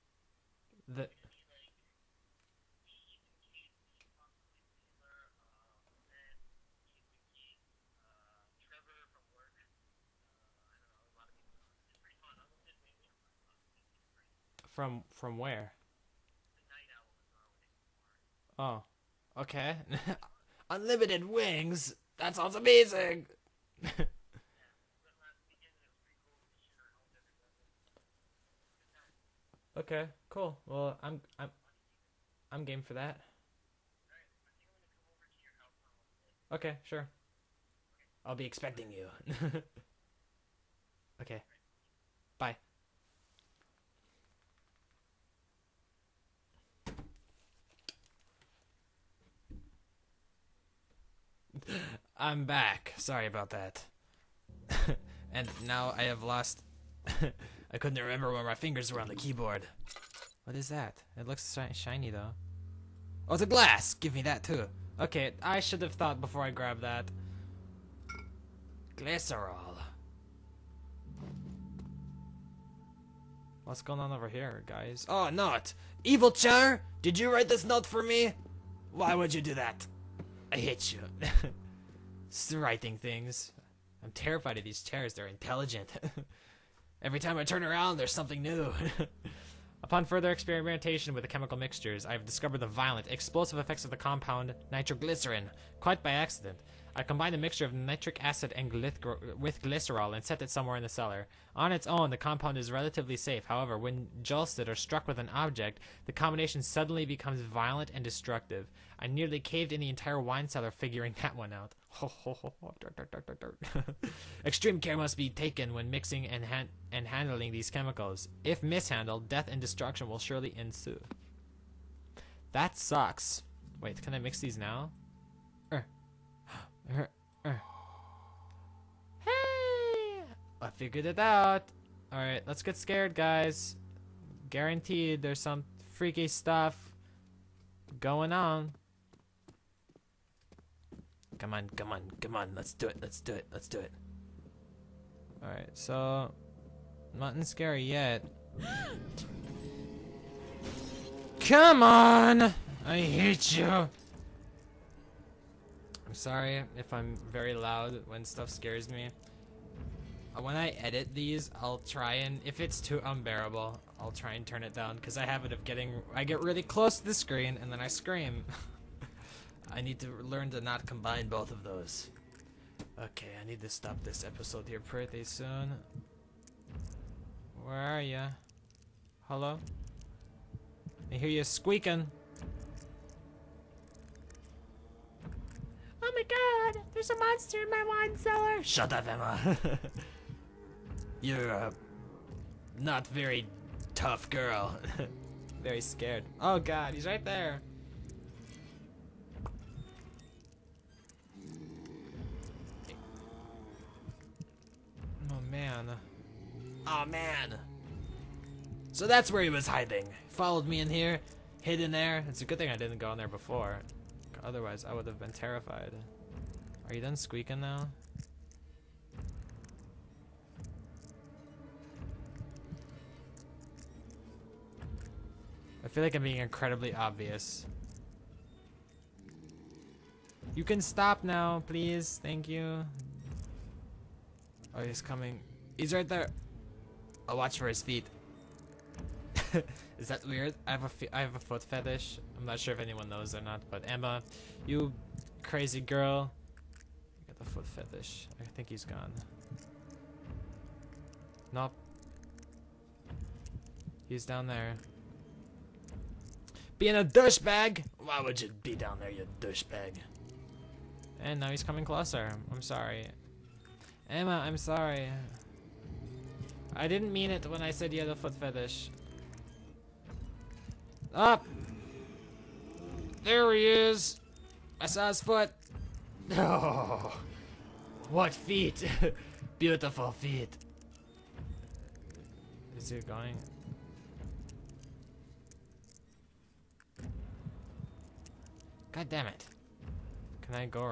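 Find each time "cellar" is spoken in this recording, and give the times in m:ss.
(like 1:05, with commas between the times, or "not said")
1:40, 1:50, 3:08.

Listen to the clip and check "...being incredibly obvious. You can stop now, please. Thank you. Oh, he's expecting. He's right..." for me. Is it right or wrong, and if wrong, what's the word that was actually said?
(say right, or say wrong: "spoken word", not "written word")
wrong: "coming", not "expecting".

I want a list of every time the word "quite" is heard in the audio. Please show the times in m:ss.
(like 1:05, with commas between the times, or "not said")
1:35.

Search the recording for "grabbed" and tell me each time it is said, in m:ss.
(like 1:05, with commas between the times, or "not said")
1:06.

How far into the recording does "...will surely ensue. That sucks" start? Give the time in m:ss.
2:00.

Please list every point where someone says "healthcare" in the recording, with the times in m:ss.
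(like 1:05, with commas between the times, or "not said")
not said.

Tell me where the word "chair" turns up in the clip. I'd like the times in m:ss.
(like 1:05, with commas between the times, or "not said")
1:16, 1:24.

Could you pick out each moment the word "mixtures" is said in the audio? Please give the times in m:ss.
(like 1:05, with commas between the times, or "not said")
1:31, 1:37.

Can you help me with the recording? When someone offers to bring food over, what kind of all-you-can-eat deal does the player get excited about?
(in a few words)
Unlimited wings.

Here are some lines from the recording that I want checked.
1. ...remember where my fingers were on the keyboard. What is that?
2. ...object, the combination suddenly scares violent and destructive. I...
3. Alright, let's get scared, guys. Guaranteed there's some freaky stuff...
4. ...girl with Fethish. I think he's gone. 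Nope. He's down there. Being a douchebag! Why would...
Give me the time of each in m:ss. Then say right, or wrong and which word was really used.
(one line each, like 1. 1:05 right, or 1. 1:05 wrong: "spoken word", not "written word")
1. 0:58 right
2. 1:45 wrong: "becomes", not "scares"
3. 2:12 right
4. 4:05 right.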